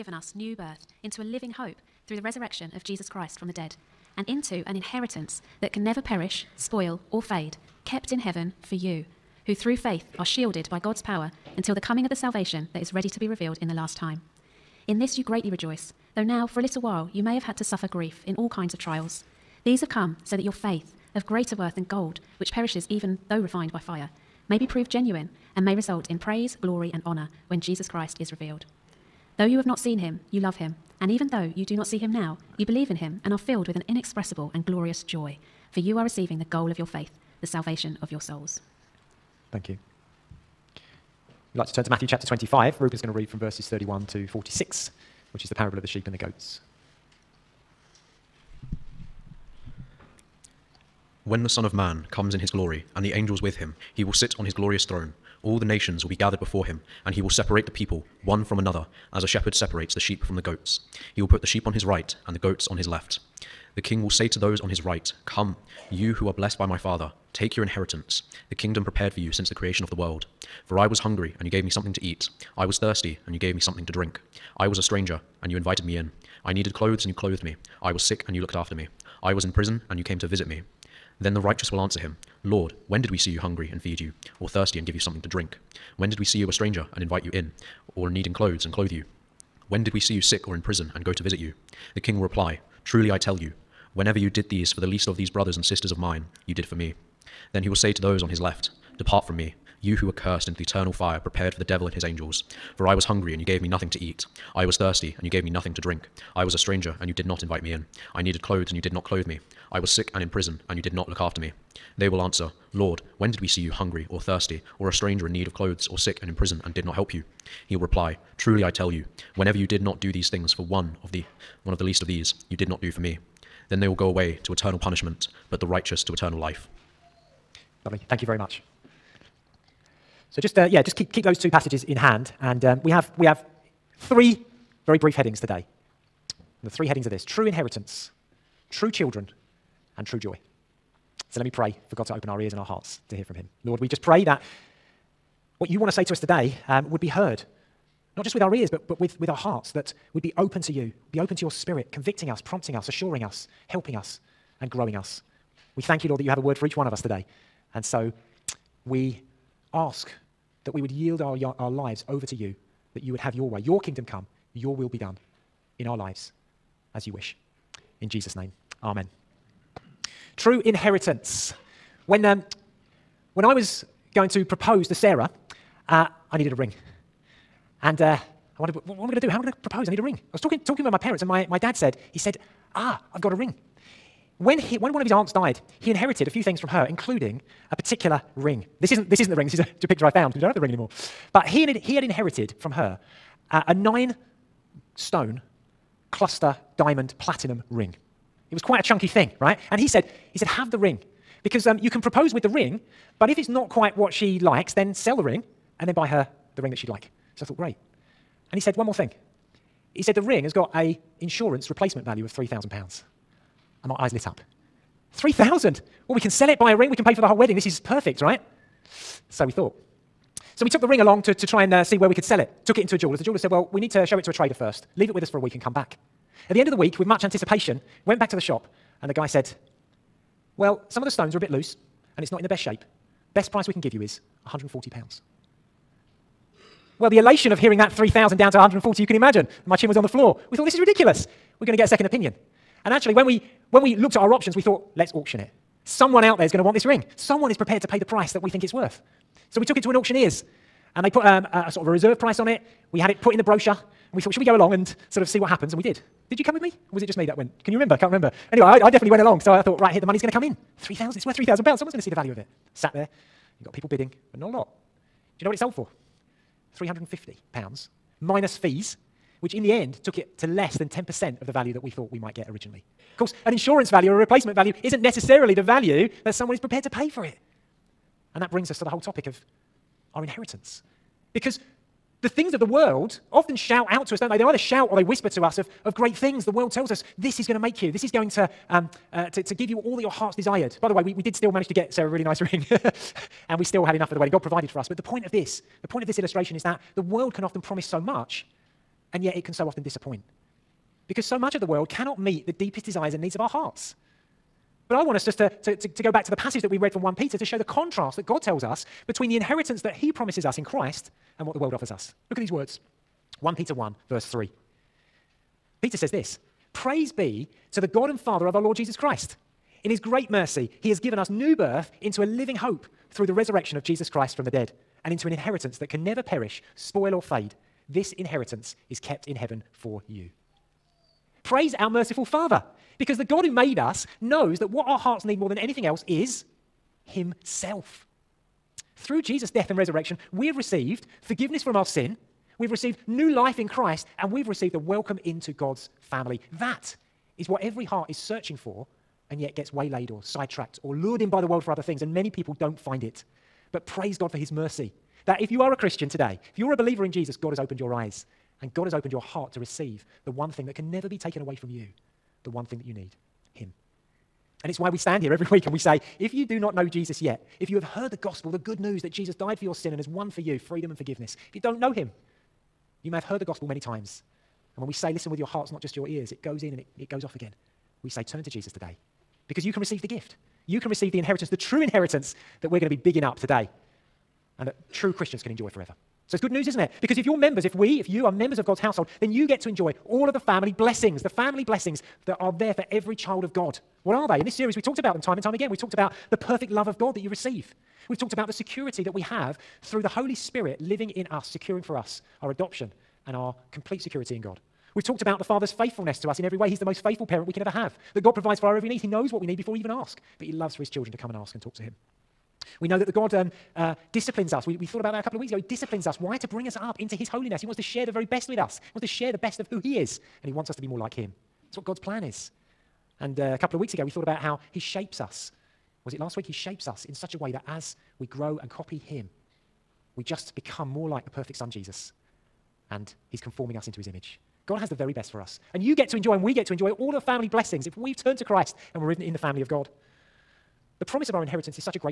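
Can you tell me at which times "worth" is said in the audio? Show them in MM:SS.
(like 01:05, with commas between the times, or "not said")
00:21, 04:08, 04:21.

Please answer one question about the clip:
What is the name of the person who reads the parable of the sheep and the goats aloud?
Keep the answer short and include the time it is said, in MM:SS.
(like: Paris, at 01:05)
Reuben, at 00:42.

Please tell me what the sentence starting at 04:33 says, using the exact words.
Of course, an insurance value or a replacement value isn't necessarily the value that someone is prepared to pay for it.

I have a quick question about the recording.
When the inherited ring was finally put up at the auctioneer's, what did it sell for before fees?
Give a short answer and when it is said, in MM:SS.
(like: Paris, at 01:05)
£350, at 04:26.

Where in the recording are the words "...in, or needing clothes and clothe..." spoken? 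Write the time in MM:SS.
01:27.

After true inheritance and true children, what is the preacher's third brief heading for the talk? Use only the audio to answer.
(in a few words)
true joy.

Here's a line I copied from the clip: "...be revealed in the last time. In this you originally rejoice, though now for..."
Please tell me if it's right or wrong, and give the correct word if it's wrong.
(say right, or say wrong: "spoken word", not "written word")
wrong: "greatly", not "originally".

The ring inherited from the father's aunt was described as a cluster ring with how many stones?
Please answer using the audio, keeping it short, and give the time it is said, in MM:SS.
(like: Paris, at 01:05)
9, at 03:13.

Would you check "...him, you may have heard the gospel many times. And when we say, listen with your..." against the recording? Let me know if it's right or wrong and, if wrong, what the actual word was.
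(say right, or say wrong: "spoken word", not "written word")
right.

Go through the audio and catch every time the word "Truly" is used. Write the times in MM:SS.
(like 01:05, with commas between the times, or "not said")
01:32, 01:58.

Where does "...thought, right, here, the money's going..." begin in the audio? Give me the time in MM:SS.
04:19.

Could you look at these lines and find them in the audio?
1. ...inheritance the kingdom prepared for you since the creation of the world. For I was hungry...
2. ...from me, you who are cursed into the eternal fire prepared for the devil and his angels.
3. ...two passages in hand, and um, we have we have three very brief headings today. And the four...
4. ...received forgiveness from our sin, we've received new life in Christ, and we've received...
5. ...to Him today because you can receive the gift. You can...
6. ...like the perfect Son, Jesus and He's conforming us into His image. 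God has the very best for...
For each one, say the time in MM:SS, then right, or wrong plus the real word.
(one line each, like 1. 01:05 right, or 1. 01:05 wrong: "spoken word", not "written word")
1. 01:07 right
2. 01:39 right
3. 02:11 wrong: "three", not "four"
4. 05:40 right
5. 06:18 wrong: "Jesus", not "Him"
6. 07:11 right.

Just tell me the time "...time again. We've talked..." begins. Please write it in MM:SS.
06:35.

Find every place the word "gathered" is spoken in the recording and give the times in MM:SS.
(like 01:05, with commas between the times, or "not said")
00:56.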